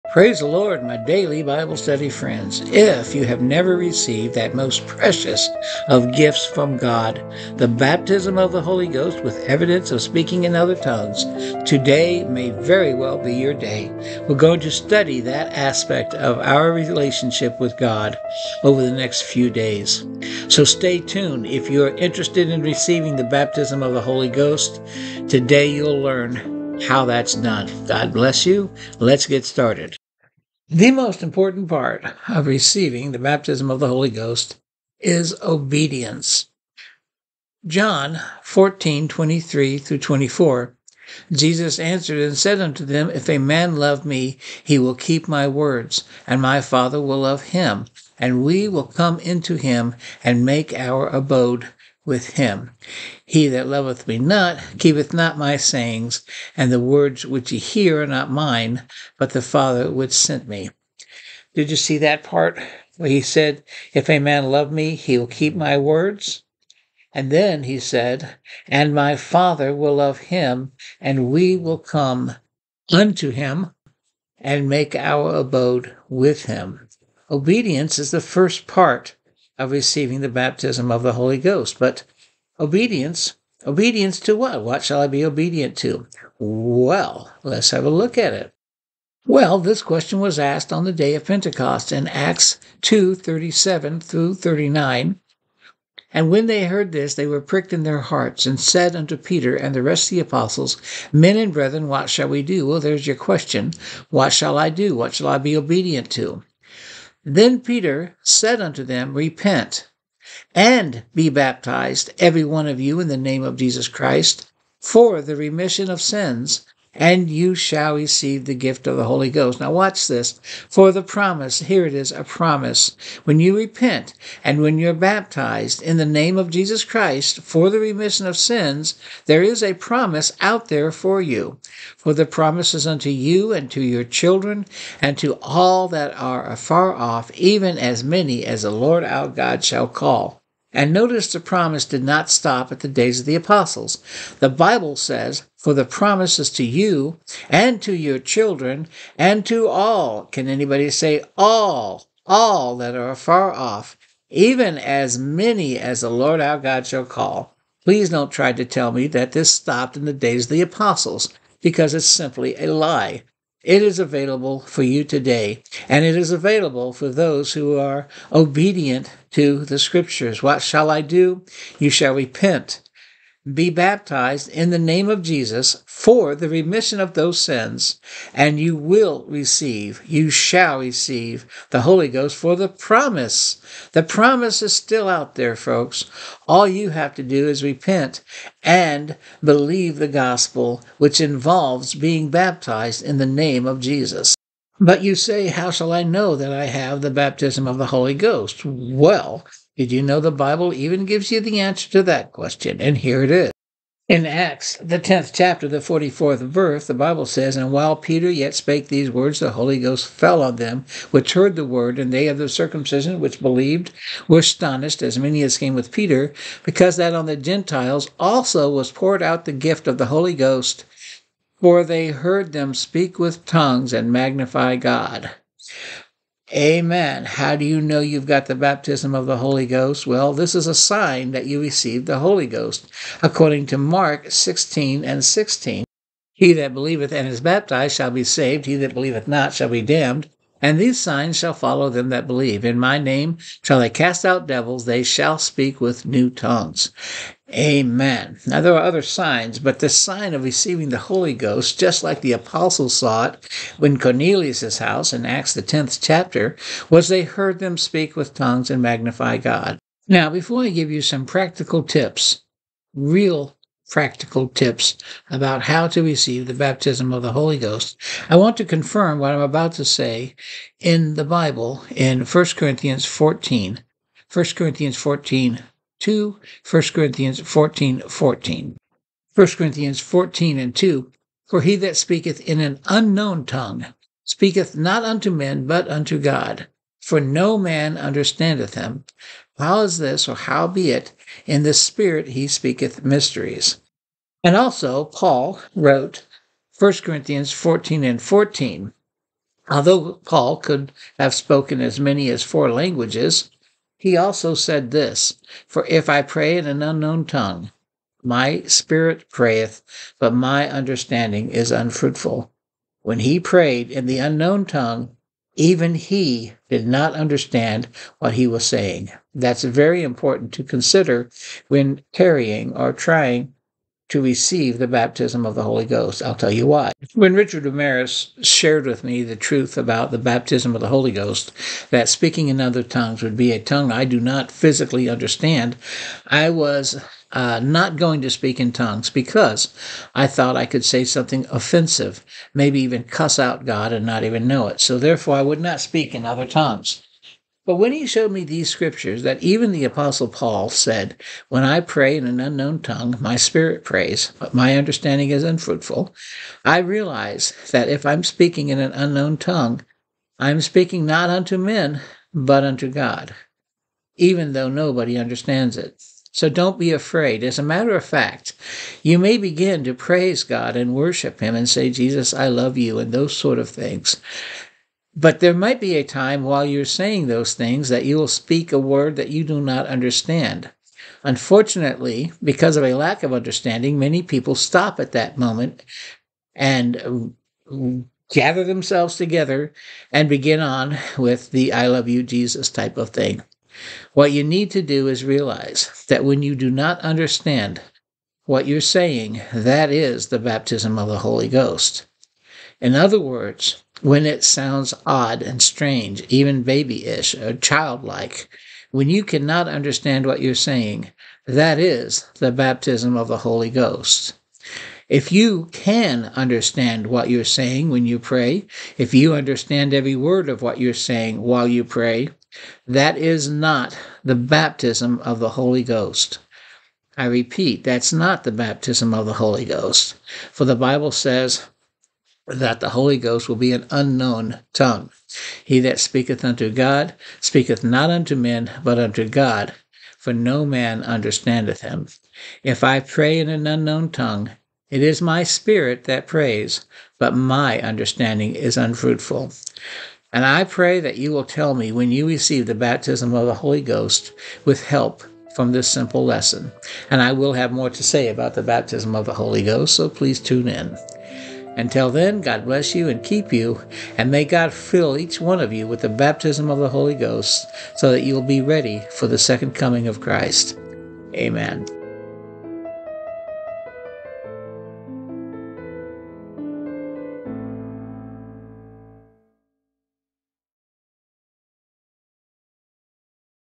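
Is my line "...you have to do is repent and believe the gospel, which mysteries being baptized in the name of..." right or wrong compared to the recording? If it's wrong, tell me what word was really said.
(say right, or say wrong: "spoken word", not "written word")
wrong: "involves", not "mysteries".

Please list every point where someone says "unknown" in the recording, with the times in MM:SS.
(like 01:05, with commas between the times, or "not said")
04:42, 05:06, 05:14, 05:52, 05:58, 07:13, 07:23.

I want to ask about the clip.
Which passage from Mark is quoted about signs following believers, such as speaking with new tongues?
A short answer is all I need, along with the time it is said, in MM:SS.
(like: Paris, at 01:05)
Mark 16:16, at 03:53.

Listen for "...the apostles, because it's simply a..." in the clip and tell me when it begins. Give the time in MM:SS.
02:40.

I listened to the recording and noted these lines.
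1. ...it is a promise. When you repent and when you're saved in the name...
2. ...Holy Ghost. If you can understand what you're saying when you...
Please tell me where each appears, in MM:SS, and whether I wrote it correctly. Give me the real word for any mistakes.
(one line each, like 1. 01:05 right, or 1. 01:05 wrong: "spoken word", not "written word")
1. 02:01 wrong: "baptized", not "saved"
2. 06:53 right.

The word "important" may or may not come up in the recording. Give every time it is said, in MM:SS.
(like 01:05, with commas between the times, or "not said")
00:31, 05:20.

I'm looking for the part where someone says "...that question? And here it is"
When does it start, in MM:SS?
03:22.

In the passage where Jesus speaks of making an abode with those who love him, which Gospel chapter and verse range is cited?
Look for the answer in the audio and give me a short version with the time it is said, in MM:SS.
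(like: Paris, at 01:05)
John 14:23-24, at 00:37.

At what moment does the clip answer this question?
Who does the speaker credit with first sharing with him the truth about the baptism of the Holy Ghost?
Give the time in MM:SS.
05:27.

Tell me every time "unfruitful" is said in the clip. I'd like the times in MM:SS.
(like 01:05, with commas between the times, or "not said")
05:11, 05:55, 07:28.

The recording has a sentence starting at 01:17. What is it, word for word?
Obedience is the first part of receiving the baptism of the Holy Ghost.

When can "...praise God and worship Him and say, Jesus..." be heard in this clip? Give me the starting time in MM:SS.
06:09.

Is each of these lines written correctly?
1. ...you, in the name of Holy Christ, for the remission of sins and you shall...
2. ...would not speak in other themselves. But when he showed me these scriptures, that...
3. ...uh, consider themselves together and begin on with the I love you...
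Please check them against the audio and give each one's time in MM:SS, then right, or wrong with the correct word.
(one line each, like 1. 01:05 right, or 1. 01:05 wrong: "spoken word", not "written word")
1. 01:52 wrong: "Jesus", not "Holy"
2. 05:45 wrong: "tongues", not "themselves"
3. 06:27 wrong: "gather", not "consider".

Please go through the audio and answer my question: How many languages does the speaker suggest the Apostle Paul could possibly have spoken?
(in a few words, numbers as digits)
4.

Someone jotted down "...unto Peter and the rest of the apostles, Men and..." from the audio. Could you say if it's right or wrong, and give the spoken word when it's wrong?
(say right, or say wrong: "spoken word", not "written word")
right.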